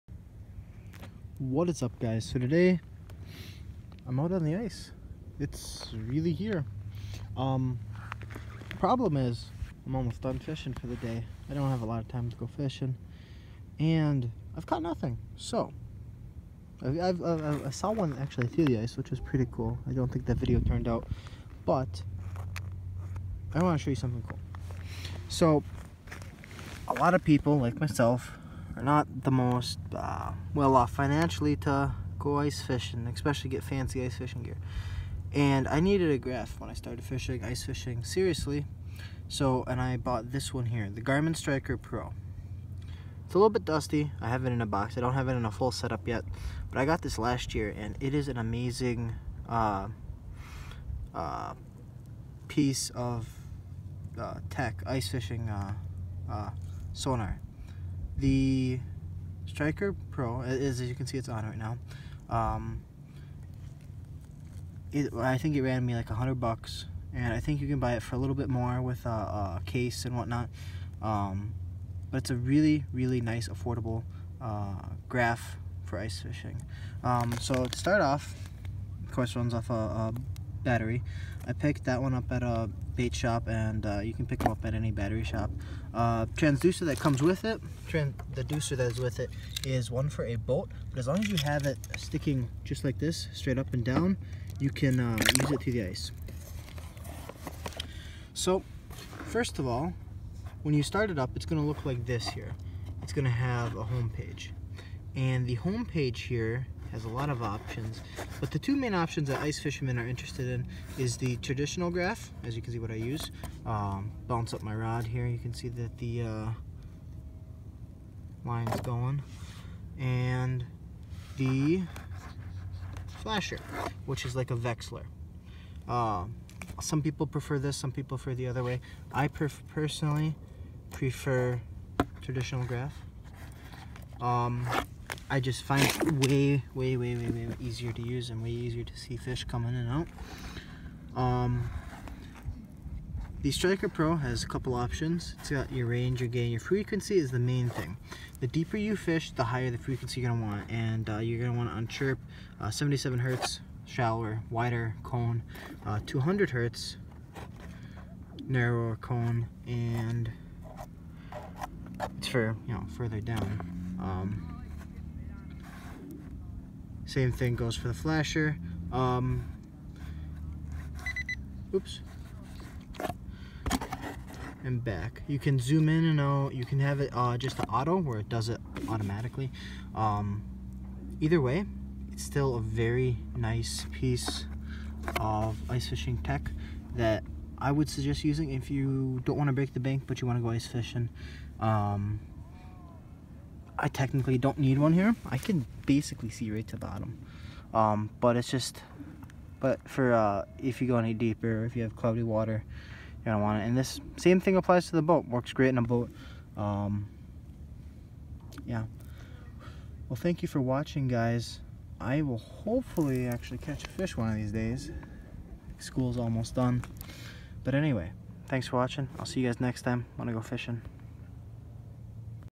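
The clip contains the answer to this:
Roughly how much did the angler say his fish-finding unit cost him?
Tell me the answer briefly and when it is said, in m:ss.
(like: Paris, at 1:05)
$100, at 1:06.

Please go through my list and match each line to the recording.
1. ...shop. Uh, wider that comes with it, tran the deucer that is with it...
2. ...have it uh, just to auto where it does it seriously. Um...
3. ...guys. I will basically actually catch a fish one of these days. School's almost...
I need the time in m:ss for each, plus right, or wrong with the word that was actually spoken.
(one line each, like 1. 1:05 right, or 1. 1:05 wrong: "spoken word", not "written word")
1. 1:25 wrong: "transducer", not "wider"
2. 2:56 wrong: "automatically", not "seriously"
3. 3:31 wrong: "hopefully", not "basically".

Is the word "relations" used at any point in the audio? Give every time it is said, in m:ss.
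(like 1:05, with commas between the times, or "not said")
not said.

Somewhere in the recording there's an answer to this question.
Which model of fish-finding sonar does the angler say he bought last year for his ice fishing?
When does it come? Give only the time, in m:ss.
0:41.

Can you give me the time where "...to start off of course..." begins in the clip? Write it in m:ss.
1:17.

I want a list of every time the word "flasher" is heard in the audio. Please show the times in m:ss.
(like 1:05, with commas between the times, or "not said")
2:03, 2:47.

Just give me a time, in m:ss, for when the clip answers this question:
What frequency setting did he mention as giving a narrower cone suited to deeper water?
2:36.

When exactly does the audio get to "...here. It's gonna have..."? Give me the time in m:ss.
1:42.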